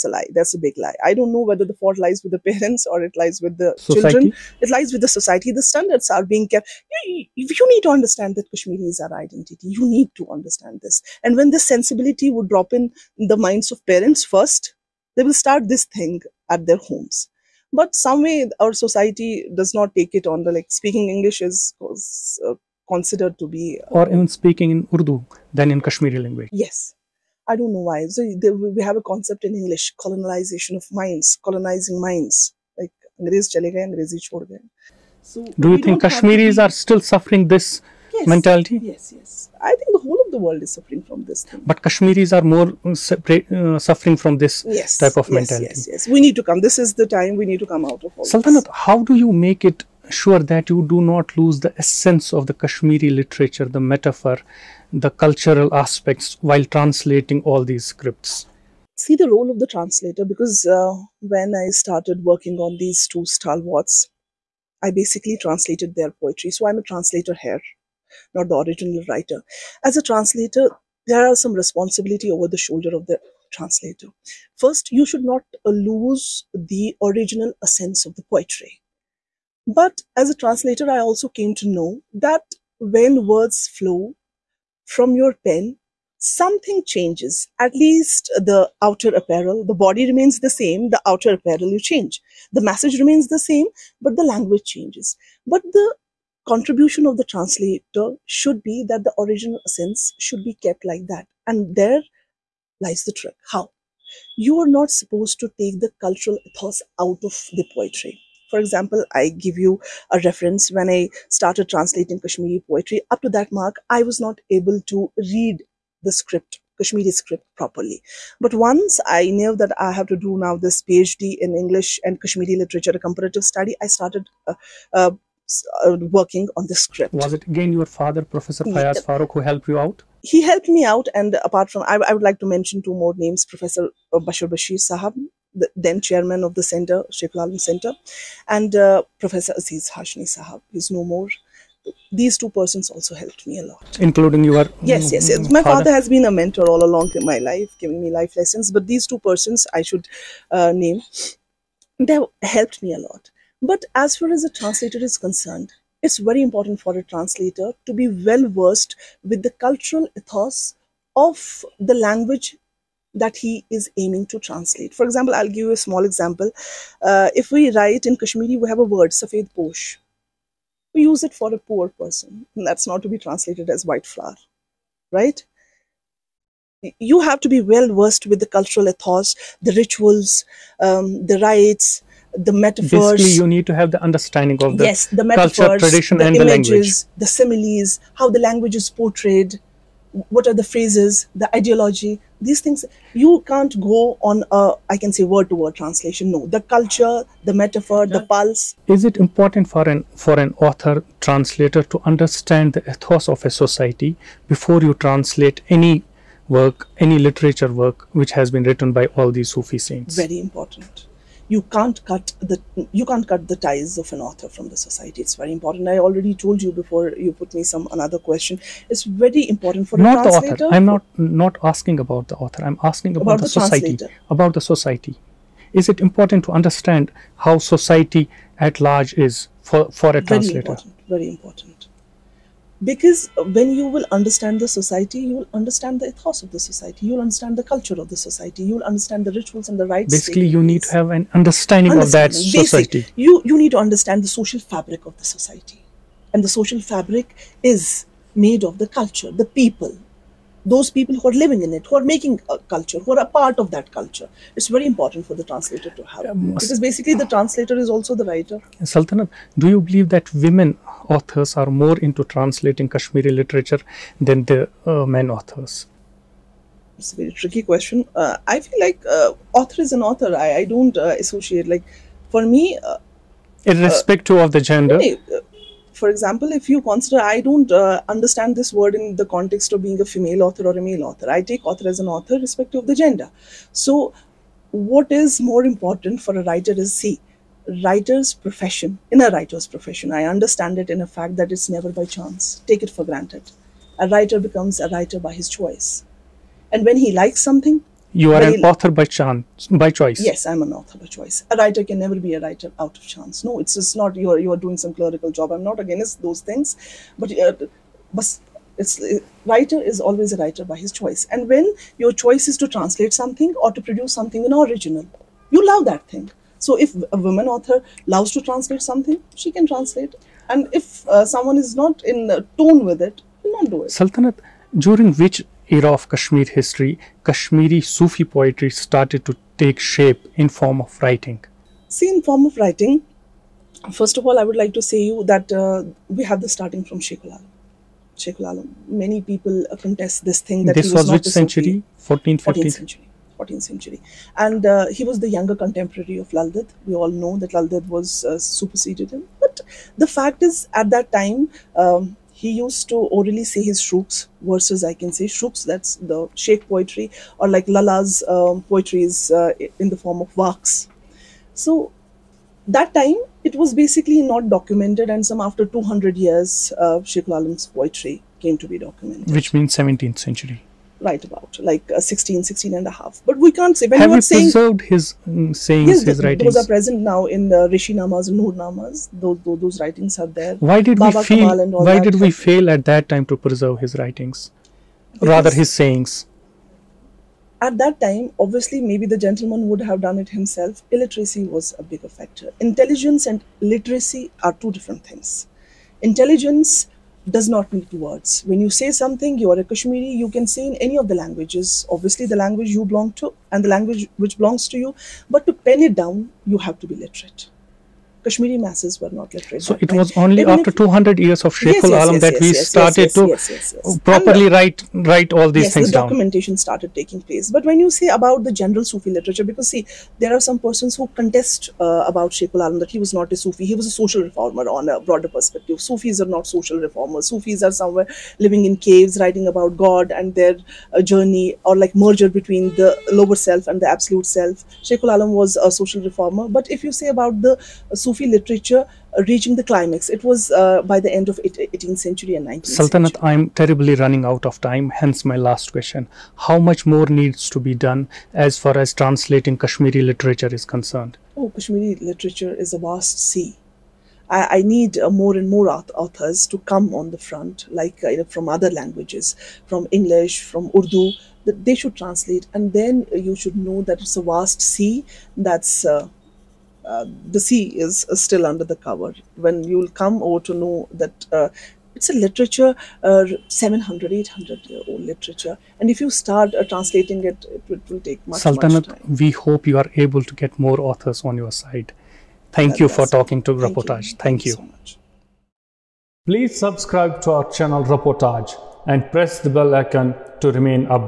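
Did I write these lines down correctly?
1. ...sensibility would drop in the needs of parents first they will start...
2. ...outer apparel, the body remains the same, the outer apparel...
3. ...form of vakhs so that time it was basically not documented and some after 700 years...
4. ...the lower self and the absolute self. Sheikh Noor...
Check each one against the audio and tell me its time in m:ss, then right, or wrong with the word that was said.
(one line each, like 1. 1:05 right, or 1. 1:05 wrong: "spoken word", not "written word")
1. 0:11 wrong: "minds", not "needs"
2. 1:28 right
3. 6:00 wrong: "200", not "700"
4. 7:12 wrong: "Alam", not "Noor".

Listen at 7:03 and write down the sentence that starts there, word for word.
He was a social reformer on a broader perspective.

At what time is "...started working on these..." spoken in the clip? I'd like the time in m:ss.
1:01.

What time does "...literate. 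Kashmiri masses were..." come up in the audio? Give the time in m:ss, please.
6:46.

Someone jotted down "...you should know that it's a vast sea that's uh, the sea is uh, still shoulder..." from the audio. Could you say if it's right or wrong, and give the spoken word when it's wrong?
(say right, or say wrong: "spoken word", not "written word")
wrong: "under", not "shoulder".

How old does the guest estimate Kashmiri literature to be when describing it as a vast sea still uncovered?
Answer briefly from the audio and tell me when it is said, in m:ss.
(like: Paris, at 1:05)
700 to 800 years, at 7:53.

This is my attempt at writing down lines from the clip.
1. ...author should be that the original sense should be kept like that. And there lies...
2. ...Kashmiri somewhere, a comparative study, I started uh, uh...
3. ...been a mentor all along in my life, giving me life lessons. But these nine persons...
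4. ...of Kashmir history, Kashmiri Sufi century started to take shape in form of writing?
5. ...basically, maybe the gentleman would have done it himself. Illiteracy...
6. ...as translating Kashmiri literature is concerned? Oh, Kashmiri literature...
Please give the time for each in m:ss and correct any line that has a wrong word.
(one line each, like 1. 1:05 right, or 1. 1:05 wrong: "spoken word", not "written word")
1. 1:37 wrong: "translator", not "author"
2. 2:02 wrong: "literature", not "somewhere"
3. 2:26 wrong: "two", not "nine"
4. 5:25 wrong: "poetry", not "century"
5. 6:28 wrong: "obviously", not "basically"
6. 7:28 right.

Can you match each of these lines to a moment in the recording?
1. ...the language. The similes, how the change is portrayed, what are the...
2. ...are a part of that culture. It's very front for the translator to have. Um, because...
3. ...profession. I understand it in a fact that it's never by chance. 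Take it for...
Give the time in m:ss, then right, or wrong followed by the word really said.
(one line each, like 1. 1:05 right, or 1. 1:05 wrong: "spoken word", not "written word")
1. 3:06 wrong: "language", not "change"
2. 4:13 wrong: "important", not "front"
3. 4:49 right.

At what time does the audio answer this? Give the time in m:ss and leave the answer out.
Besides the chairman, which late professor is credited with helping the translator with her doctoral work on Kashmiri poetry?
2:19.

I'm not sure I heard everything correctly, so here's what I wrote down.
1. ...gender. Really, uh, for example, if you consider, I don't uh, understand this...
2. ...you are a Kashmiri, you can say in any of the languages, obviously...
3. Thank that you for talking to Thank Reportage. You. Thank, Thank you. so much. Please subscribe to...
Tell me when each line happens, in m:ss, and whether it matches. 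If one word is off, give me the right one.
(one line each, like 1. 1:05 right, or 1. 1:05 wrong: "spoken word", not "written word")
1. 4:34 right
2. 6:39 right
3. 8:02 right.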